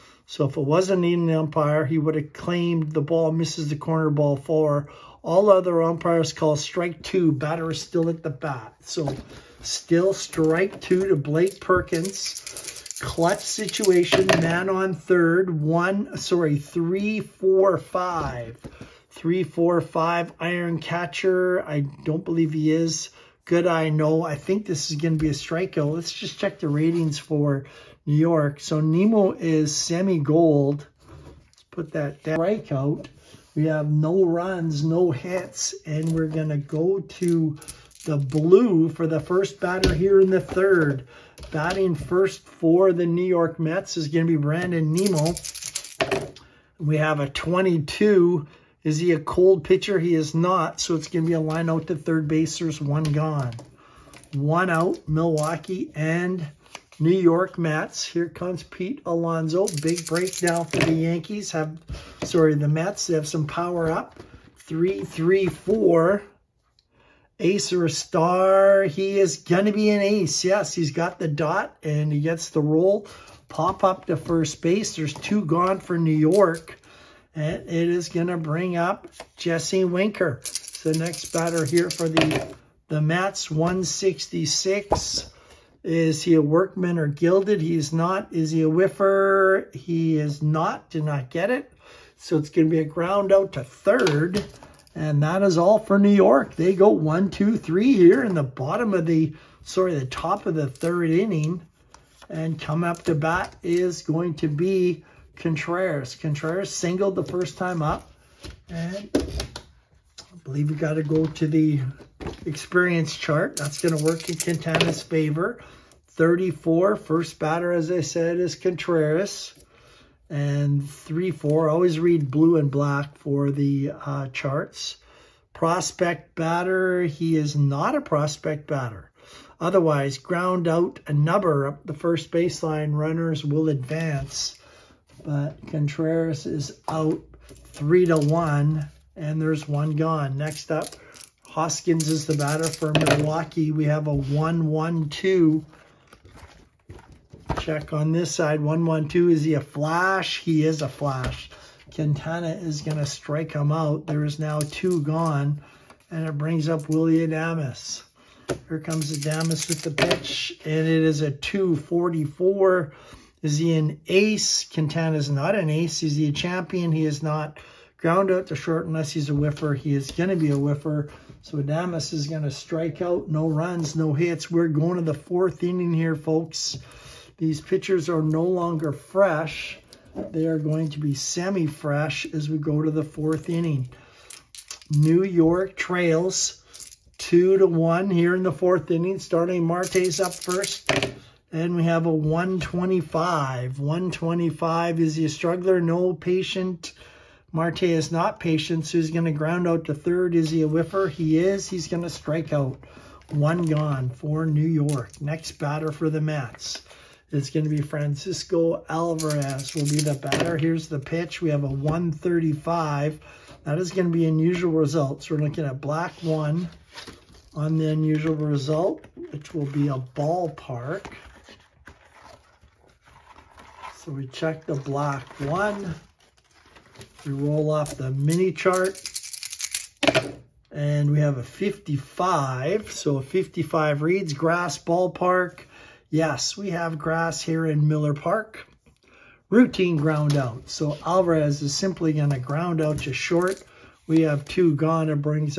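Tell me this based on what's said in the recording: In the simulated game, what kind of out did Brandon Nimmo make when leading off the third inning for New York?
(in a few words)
Line out to third base.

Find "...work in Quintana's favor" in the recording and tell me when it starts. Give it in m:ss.
1:54.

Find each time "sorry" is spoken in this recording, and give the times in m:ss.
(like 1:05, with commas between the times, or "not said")
0:16, 1:02, 1:39.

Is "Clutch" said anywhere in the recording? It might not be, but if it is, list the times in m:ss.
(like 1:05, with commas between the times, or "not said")
0:13.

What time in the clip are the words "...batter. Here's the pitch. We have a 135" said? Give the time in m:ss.
3:30.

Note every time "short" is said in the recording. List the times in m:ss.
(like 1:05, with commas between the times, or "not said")
2:48, 4:03.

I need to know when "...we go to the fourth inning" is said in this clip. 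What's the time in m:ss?
3:02.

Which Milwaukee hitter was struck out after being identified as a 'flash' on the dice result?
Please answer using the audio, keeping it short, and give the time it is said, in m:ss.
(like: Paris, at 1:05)
Hoskins, at 2:21.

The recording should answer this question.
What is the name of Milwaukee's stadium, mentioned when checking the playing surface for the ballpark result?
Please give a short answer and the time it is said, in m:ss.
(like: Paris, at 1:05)
Miller Park, at 3:57.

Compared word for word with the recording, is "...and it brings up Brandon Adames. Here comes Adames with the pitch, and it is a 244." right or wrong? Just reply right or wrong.
wrong.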